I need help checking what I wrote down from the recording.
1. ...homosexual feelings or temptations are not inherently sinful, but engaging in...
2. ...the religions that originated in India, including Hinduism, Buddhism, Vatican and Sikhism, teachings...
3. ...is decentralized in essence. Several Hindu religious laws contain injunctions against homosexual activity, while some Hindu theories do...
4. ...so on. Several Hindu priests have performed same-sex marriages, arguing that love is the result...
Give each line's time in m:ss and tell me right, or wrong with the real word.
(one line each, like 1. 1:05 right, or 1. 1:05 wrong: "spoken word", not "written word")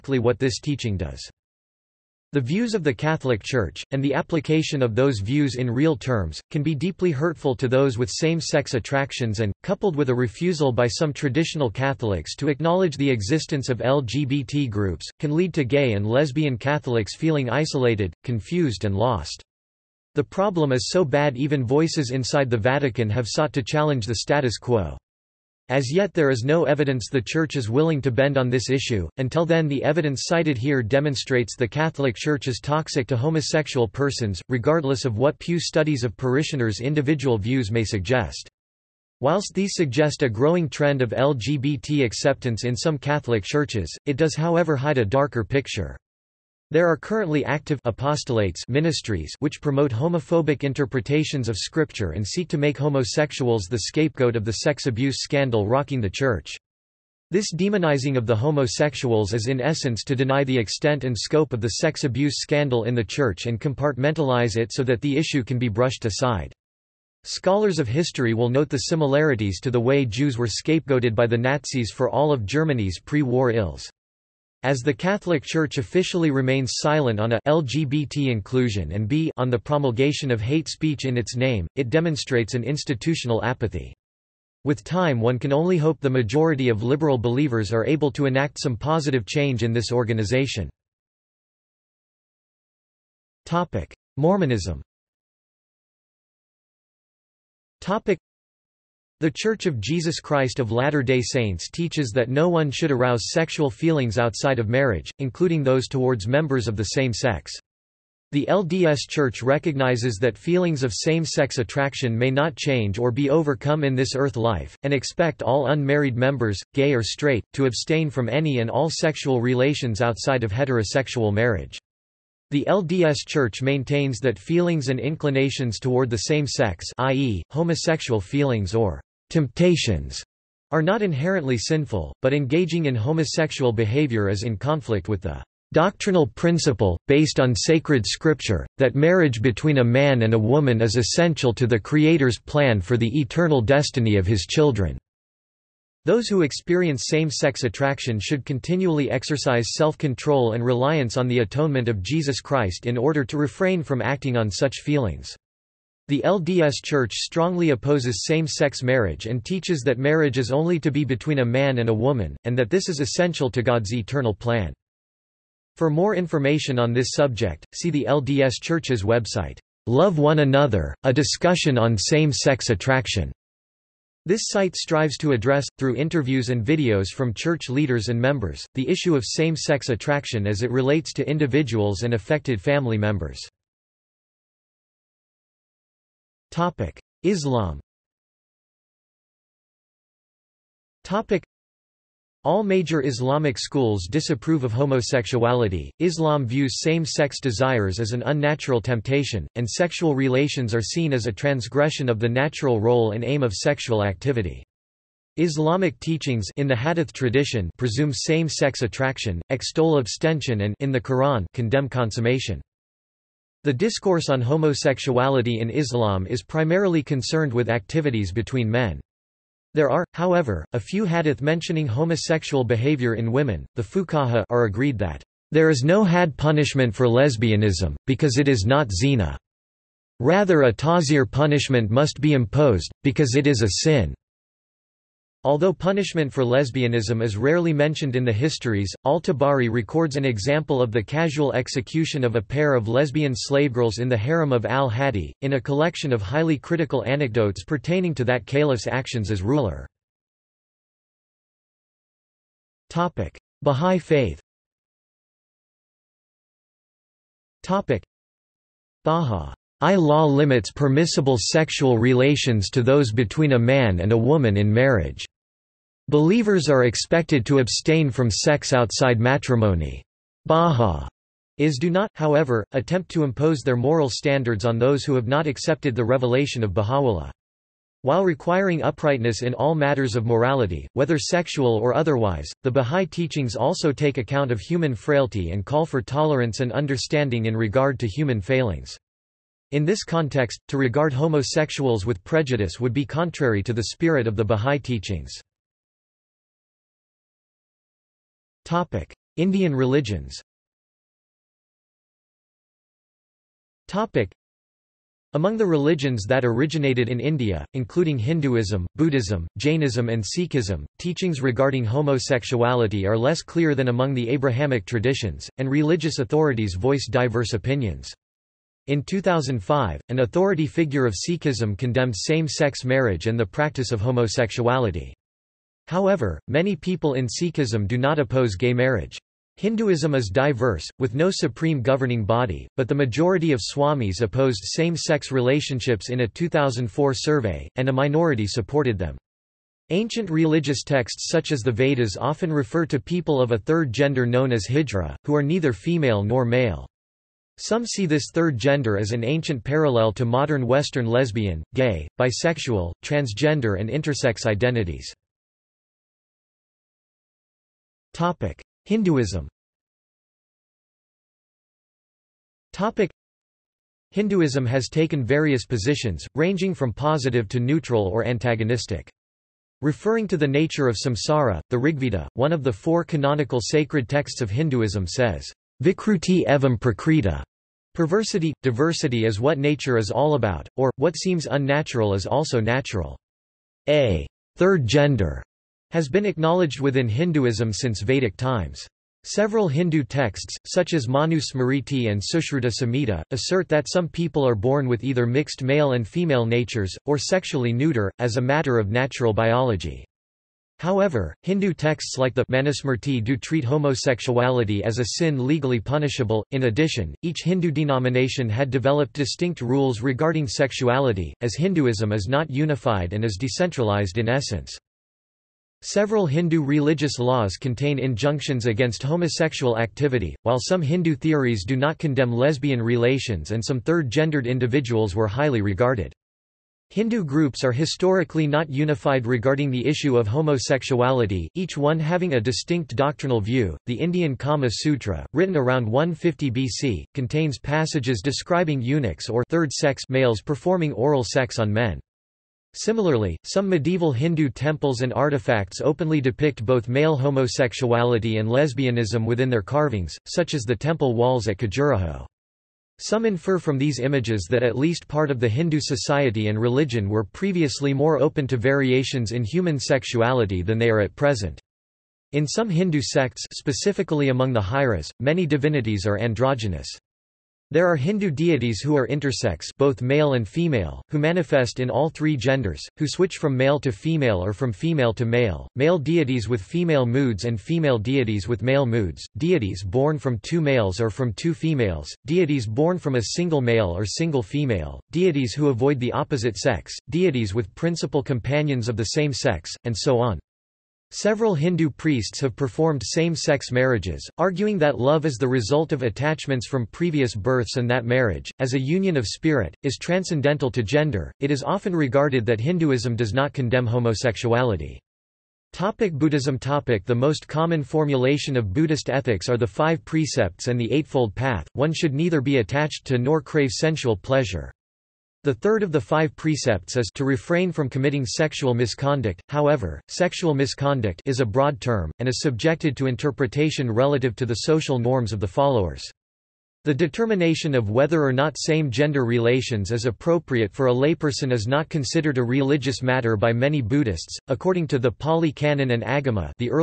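1. 2:07 right
2. 5:05 wrong: "Jainism", not "Vatican"
3. 6:53 right
4. 8:09 right.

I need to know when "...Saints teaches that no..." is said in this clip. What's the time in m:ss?
1:41.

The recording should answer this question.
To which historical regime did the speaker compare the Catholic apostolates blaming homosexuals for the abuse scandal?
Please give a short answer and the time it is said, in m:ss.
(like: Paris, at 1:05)
The Nazis, at 1:11.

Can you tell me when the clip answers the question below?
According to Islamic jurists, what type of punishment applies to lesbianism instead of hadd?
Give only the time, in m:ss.
3:50.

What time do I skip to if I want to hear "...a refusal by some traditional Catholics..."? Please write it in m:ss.
0:10.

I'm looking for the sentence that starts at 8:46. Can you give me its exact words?
The determination of whether or not same-gender relations is appropriate for a layperson is not considered a religious matter by many Buddhists.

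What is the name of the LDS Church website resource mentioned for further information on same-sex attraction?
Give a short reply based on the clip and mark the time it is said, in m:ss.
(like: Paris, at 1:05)
Love One Another, at 2:49.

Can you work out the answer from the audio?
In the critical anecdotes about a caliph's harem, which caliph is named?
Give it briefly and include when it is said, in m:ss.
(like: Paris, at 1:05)
al-Hadi, at 4:04.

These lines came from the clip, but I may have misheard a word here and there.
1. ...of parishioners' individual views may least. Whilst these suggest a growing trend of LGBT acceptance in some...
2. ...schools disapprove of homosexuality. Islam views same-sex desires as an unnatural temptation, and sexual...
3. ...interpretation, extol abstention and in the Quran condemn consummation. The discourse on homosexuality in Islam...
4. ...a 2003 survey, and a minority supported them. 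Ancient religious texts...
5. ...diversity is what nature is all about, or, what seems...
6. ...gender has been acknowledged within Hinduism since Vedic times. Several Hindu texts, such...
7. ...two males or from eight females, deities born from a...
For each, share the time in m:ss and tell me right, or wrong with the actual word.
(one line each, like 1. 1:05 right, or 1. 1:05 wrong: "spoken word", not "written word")
1. 0:36 wrong: "suggest", not "least"
2. 3:13 right
3. 3:28 wrong: "attraction", not "interpretation"
4. 5:36 wrong: "2004", not "2003"
5. 6:18 right
6. 6:24 right
7. 8:00 wrong: "two", not "eight".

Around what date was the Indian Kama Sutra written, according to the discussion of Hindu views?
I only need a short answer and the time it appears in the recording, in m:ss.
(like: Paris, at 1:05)
150 BC, at 7:15.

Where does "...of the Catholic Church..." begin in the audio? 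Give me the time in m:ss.
0:02.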